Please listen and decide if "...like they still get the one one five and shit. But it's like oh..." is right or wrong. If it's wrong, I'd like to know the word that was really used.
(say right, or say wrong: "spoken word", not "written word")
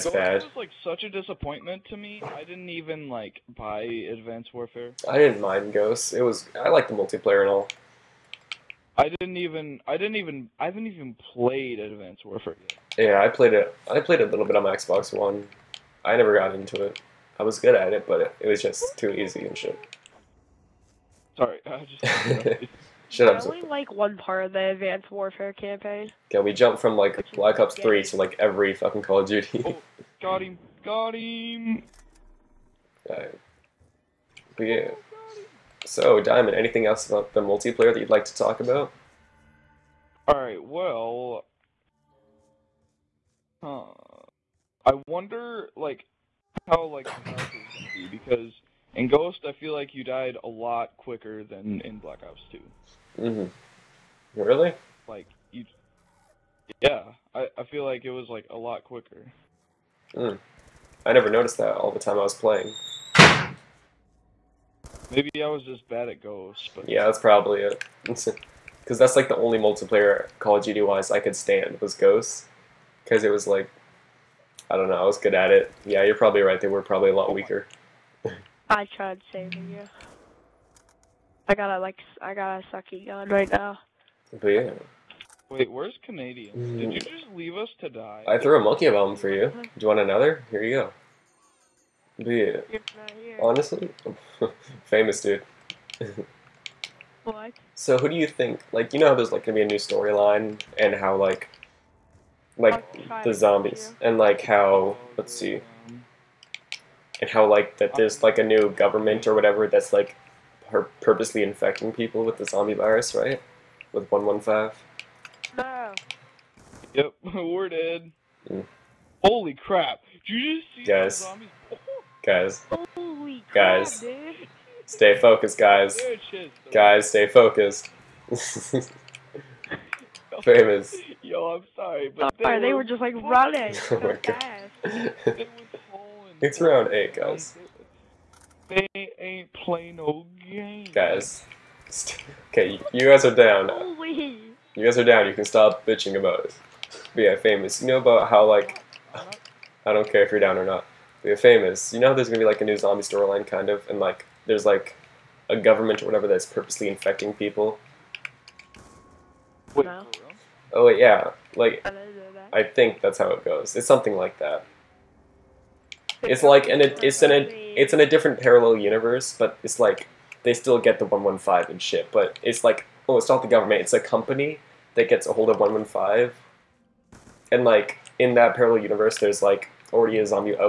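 right.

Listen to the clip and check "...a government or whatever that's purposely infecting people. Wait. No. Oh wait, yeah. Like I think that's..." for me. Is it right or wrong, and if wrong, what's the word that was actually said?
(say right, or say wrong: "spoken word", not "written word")
right.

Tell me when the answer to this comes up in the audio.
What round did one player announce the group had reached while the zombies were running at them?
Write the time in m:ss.
2:16.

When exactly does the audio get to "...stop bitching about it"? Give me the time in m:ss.
2:25.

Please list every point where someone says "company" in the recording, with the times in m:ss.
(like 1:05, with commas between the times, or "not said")
2:53.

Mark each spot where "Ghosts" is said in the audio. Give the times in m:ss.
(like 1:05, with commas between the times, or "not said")
0:05, 0:49, 1:06, 1:11.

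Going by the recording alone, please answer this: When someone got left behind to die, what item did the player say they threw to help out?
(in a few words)
monkey bomb.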